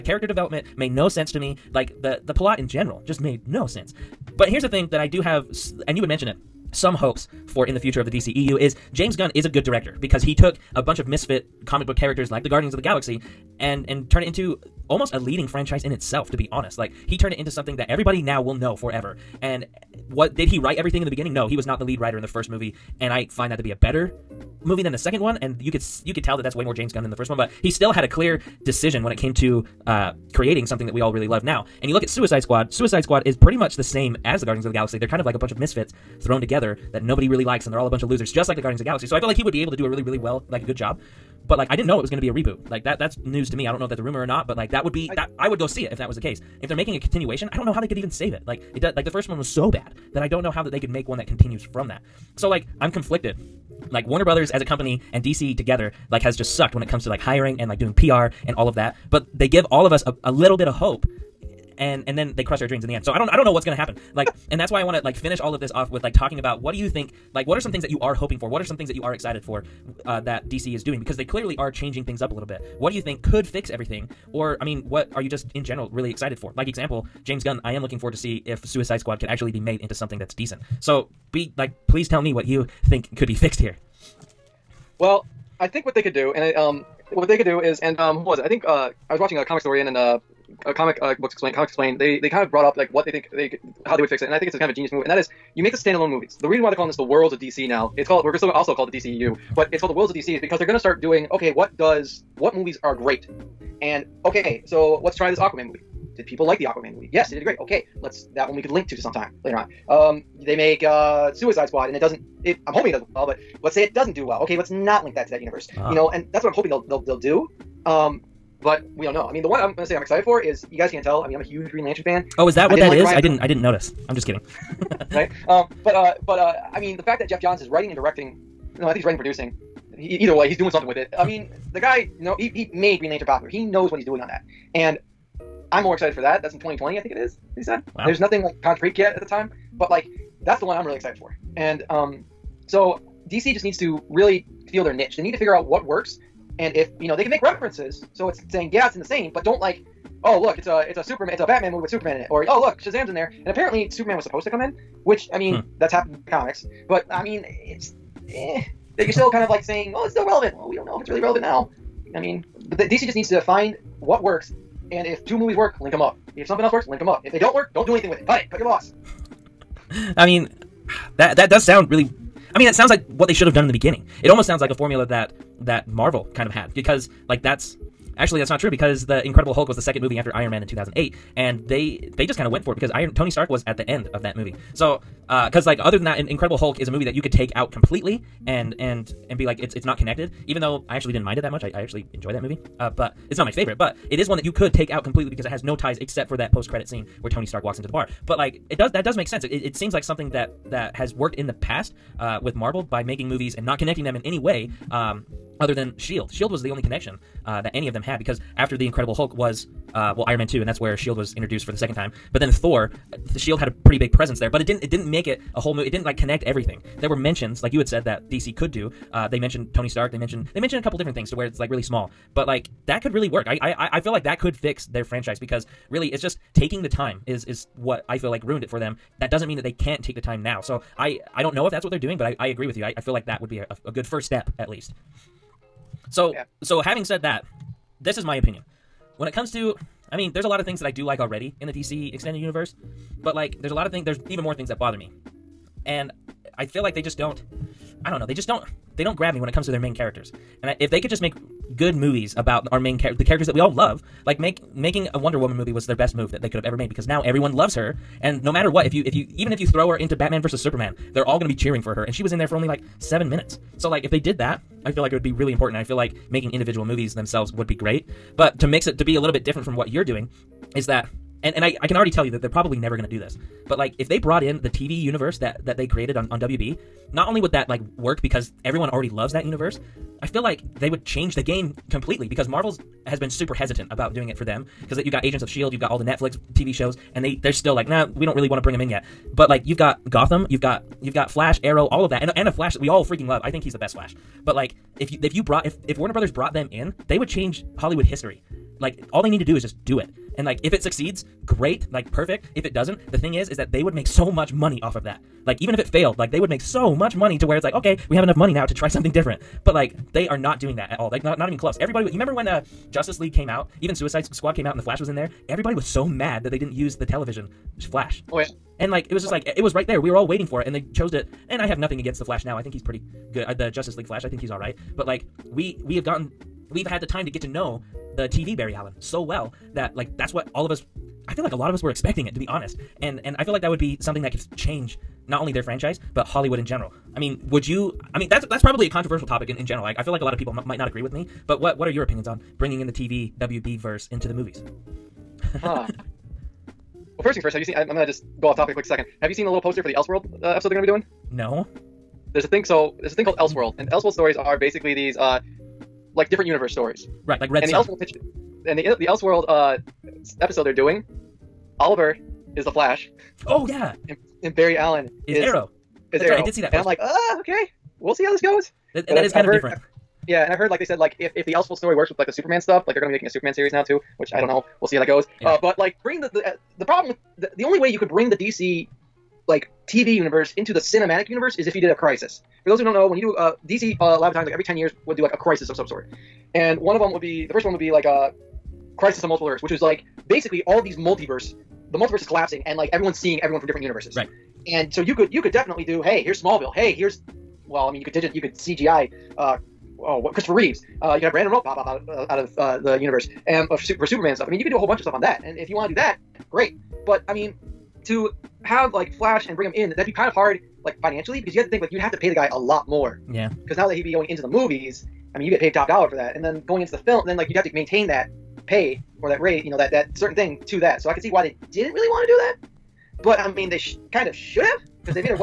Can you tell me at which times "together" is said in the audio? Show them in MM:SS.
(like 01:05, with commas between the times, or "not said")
00:36, 00:55.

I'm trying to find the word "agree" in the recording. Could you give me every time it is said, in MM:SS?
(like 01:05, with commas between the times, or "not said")
03:52, 05:40.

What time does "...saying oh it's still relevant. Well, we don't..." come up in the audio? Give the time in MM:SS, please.
02:39.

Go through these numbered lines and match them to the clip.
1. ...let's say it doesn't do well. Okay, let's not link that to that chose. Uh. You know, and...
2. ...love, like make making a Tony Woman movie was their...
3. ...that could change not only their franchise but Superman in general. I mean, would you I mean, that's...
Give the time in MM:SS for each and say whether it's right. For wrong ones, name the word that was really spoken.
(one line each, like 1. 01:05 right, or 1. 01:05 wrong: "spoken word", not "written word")
1. 01:53 wrong: "universe", not "chose"
2. 04:13 wrong: "Wonder", not "Tony"
3. 05:34 wrong: "Hollywood", not "Superman".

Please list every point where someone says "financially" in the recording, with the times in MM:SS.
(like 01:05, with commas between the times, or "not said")
06:51.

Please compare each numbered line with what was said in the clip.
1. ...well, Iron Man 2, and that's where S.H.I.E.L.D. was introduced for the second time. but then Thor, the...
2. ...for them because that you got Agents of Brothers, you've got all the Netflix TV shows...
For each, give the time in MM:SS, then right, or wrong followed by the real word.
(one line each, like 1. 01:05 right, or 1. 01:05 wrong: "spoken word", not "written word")
1. 03:30 right
2. 04:44 wrong: "Shield", not "Brothers".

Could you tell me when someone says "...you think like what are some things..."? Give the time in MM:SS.
01:06.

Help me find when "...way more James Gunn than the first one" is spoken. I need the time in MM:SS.
00:26.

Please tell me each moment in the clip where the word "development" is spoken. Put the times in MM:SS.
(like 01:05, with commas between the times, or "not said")
00:00.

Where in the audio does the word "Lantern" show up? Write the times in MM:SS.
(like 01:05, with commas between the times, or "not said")
02:01, 02:13.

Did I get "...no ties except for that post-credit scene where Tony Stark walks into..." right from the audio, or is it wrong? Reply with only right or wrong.
right.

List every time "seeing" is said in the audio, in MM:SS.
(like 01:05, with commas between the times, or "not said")
06:33.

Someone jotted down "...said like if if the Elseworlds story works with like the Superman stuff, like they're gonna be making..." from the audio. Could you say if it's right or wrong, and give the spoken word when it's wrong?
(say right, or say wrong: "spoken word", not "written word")
right.